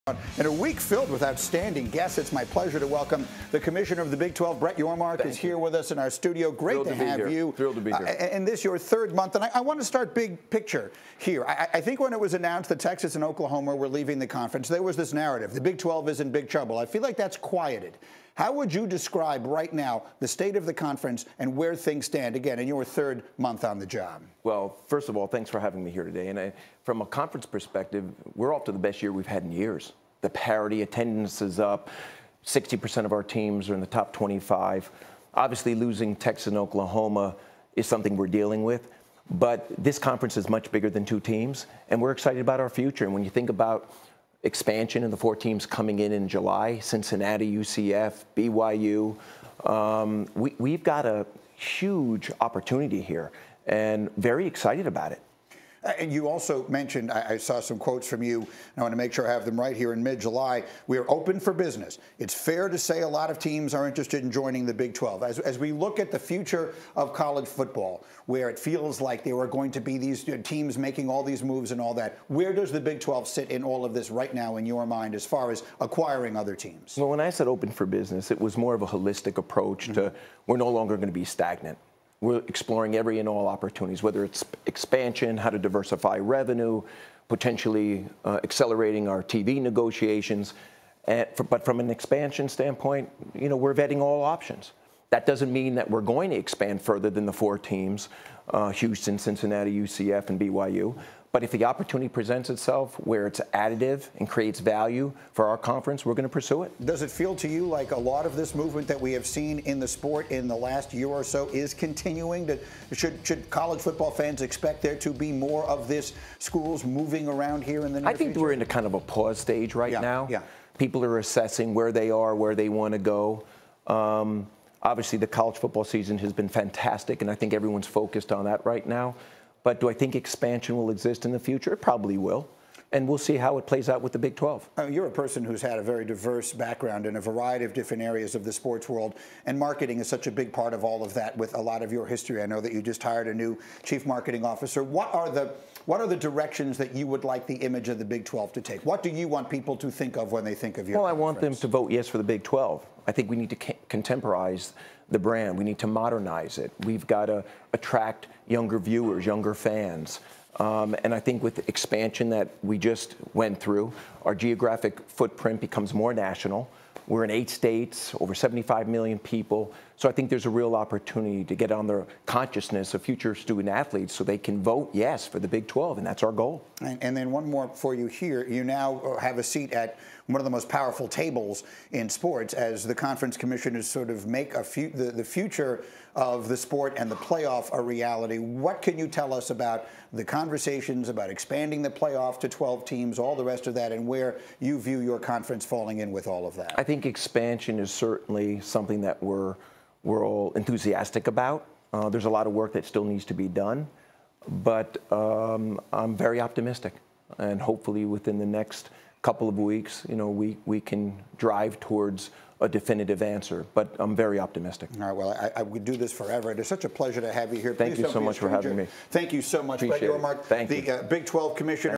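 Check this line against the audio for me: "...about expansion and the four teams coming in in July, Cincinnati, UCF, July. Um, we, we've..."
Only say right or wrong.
wrong.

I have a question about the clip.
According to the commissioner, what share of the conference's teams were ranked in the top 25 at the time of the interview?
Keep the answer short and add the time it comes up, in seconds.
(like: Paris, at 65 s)
60%, at 32 s.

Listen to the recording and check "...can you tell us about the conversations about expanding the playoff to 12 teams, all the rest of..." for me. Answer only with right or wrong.
right.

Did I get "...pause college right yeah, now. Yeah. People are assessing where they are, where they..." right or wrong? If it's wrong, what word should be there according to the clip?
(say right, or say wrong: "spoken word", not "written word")
wrong: "stage", not "college".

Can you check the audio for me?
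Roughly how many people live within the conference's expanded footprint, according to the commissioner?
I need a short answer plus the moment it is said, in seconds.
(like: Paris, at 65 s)
Over 75 million, at 168 s.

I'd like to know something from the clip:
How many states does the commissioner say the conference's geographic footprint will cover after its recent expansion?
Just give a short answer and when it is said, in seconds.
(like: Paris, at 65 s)
8, at 167 s.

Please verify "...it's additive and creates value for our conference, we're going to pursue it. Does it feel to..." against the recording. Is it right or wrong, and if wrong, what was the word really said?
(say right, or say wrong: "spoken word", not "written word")
right.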